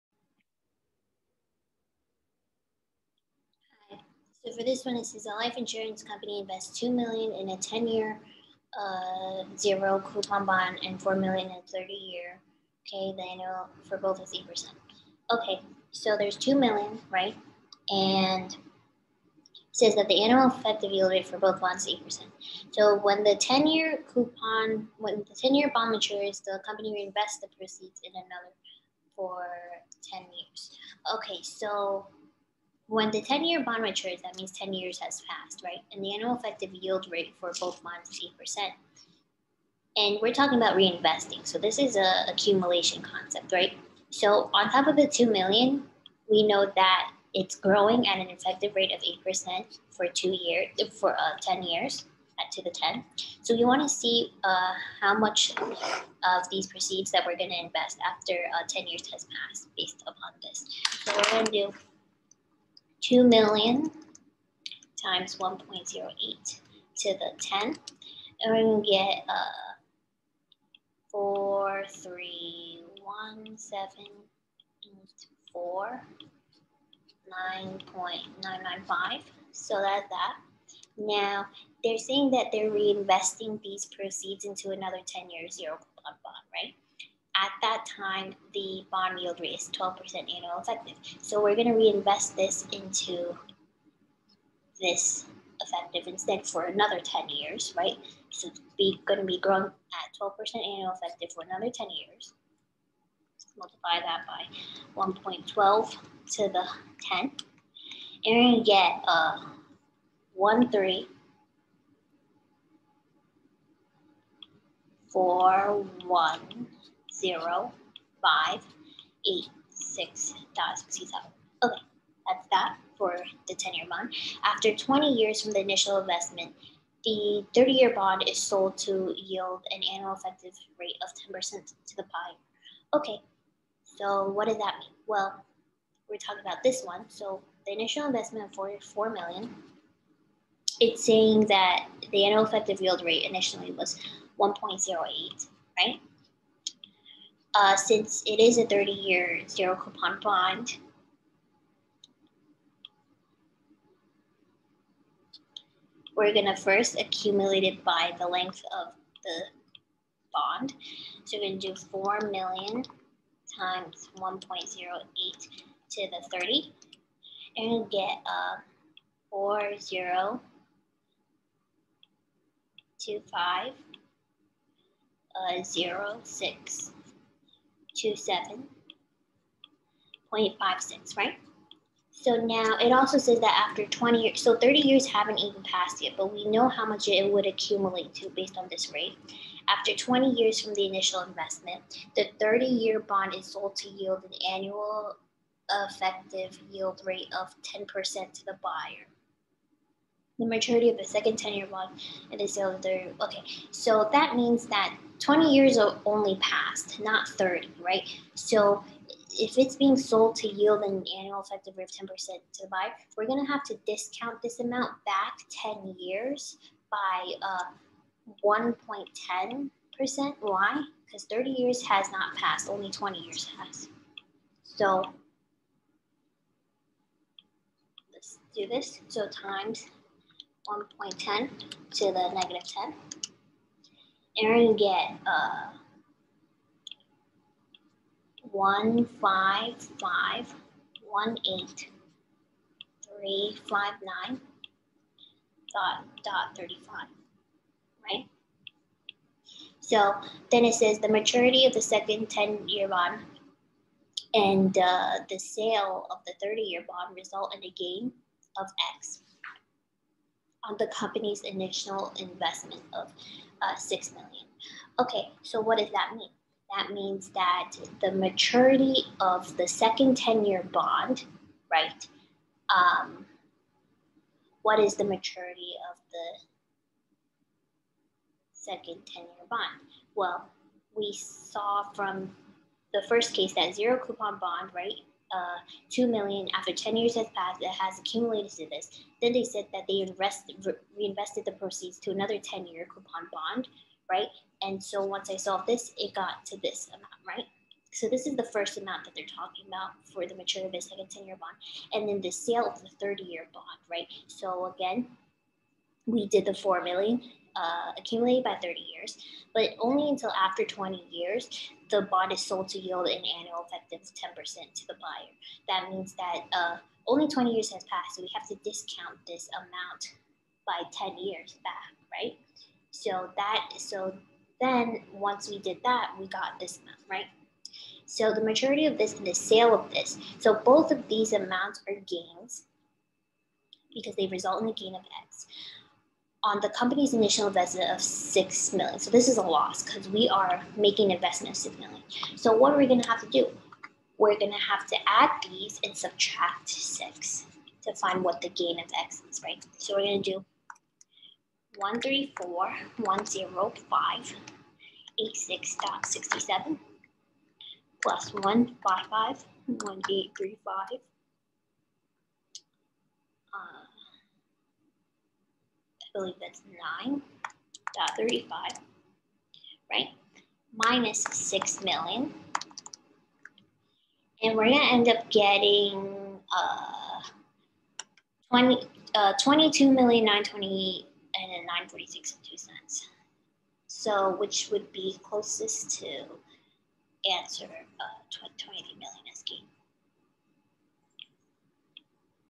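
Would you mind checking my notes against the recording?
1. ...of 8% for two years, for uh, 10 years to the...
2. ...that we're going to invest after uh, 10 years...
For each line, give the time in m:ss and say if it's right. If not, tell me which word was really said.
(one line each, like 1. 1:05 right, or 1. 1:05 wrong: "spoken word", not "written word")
1. 0:48 right
2. 0:57 right.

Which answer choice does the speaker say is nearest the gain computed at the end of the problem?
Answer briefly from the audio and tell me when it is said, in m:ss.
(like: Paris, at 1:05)
20 million, at 6:28.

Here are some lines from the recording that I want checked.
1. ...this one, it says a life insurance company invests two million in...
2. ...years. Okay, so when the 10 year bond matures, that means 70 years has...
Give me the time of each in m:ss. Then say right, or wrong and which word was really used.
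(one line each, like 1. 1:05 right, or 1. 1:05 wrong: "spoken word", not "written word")
1. 0:04 right
2. 0:30 wrong: "10", not "70".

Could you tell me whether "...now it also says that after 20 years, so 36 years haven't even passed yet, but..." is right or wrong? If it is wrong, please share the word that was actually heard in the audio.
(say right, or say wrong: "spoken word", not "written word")
wrong: "30", not "36".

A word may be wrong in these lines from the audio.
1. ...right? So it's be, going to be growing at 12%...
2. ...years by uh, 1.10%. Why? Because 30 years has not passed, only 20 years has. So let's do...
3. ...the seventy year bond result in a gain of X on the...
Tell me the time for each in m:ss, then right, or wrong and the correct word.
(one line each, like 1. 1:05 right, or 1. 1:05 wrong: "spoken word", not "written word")
1. 1:37 right
2. 3:35 right
3. 4:16 wrong: "thirty", not "seventy".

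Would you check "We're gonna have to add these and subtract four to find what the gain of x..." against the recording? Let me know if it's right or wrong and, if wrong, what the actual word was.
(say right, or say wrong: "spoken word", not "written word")
wrong: "six", not "four".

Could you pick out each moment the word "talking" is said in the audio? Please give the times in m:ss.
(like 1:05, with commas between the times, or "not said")
0:40, 2:16, 4:59.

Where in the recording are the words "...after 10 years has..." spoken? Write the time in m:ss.
4:46.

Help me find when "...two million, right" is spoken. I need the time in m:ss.
0:16.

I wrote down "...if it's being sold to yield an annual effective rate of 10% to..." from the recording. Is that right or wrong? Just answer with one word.
right.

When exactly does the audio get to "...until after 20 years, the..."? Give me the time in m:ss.
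5:10.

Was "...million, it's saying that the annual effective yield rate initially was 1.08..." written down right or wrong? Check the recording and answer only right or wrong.
right.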